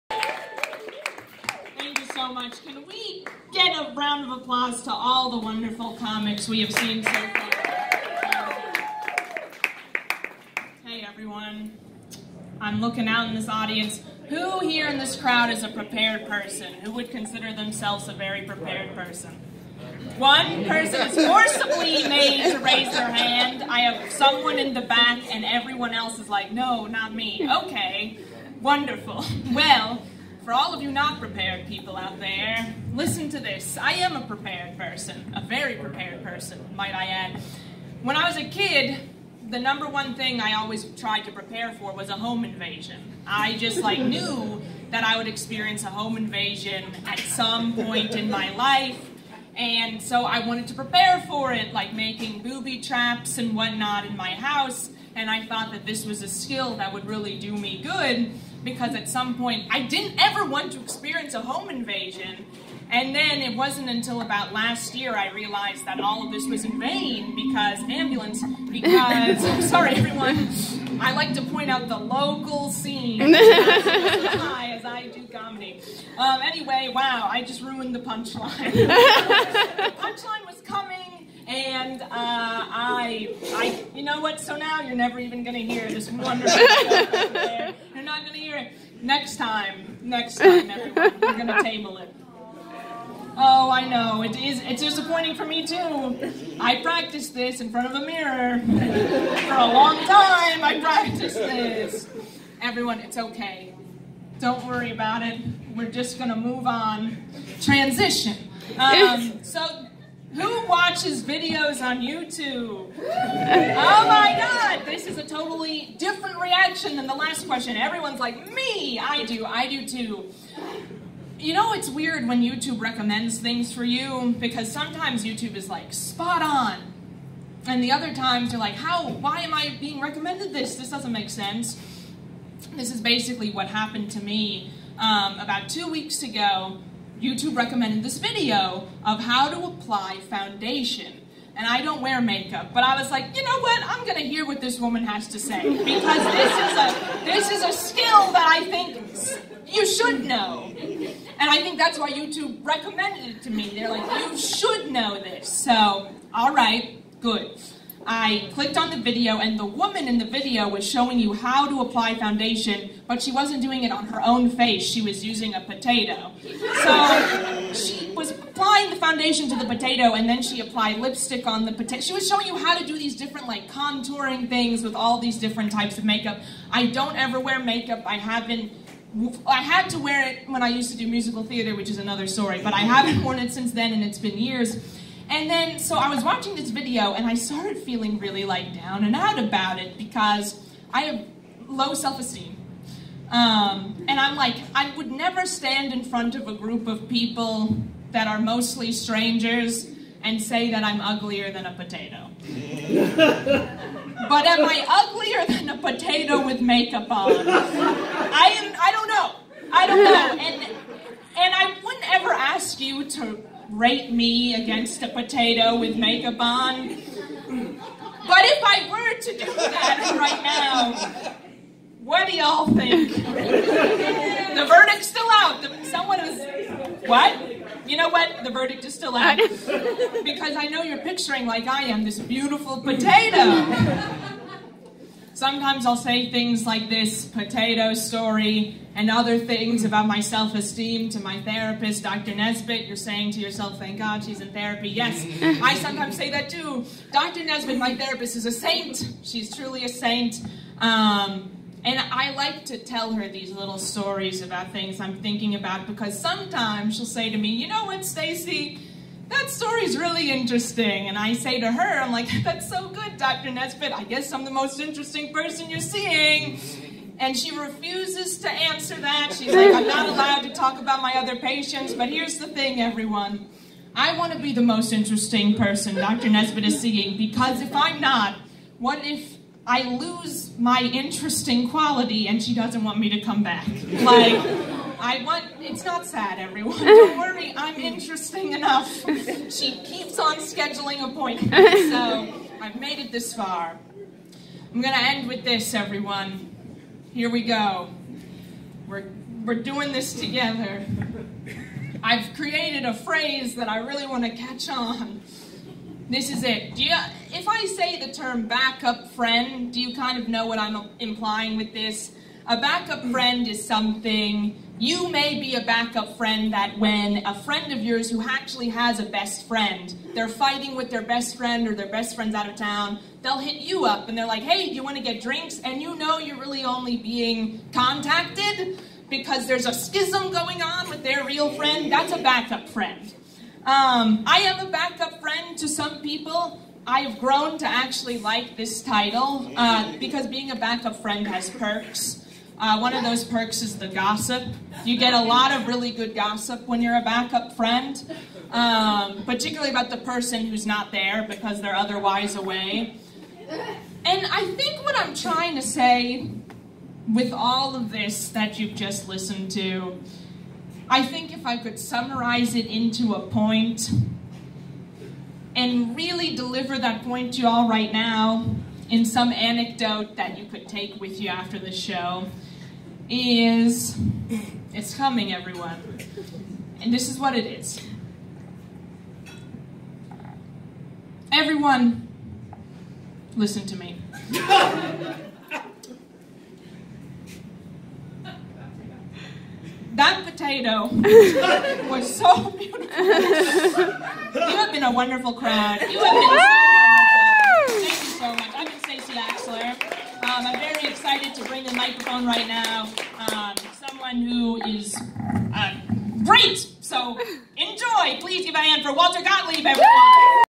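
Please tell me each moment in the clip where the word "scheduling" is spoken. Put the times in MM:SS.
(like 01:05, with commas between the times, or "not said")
04:50.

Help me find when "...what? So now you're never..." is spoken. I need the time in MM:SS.
01:24.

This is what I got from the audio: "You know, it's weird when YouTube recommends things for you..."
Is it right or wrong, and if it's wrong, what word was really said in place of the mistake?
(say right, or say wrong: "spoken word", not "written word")
right.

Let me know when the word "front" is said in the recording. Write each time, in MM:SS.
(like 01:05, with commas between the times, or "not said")
01:37, 03:16.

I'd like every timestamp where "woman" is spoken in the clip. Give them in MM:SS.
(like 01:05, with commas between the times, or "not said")
02:24, 02:39.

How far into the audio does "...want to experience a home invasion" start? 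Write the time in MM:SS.
01:00.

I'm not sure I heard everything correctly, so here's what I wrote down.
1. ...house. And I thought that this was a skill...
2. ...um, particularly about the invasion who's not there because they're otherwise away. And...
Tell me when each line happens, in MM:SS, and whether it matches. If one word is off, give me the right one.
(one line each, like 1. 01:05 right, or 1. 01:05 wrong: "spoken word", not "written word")
1. 00:54 right
2. 05:48 wrong: "person", not "invasion".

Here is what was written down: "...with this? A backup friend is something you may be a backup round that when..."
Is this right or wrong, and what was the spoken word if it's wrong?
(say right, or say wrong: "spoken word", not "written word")
wrong: "friend", not "round".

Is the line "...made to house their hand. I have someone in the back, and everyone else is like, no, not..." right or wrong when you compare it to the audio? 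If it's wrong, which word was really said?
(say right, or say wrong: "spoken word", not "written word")
wrong: "raise", not "house".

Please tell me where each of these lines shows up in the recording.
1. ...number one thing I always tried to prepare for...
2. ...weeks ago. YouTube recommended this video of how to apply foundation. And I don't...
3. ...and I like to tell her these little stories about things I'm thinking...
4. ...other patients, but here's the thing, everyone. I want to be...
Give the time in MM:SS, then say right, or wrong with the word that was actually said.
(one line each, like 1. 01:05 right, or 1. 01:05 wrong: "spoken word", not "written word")
1. 00:39 right
2. 02:15 right
3. 04:11 right
4. 04:31 right.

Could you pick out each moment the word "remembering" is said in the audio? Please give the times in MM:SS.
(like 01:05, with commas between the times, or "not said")
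not said.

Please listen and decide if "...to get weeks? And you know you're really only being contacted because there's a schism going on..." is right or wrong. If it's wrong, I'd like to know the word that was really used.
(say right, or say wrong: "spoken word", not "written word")
wrong: "drinks", not "weeks".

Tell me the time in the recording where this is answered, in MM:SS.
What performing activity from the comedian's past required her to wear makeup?
03:01.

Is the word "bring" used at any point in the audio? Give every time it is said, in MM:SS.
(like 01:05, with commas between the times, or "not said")
06:41.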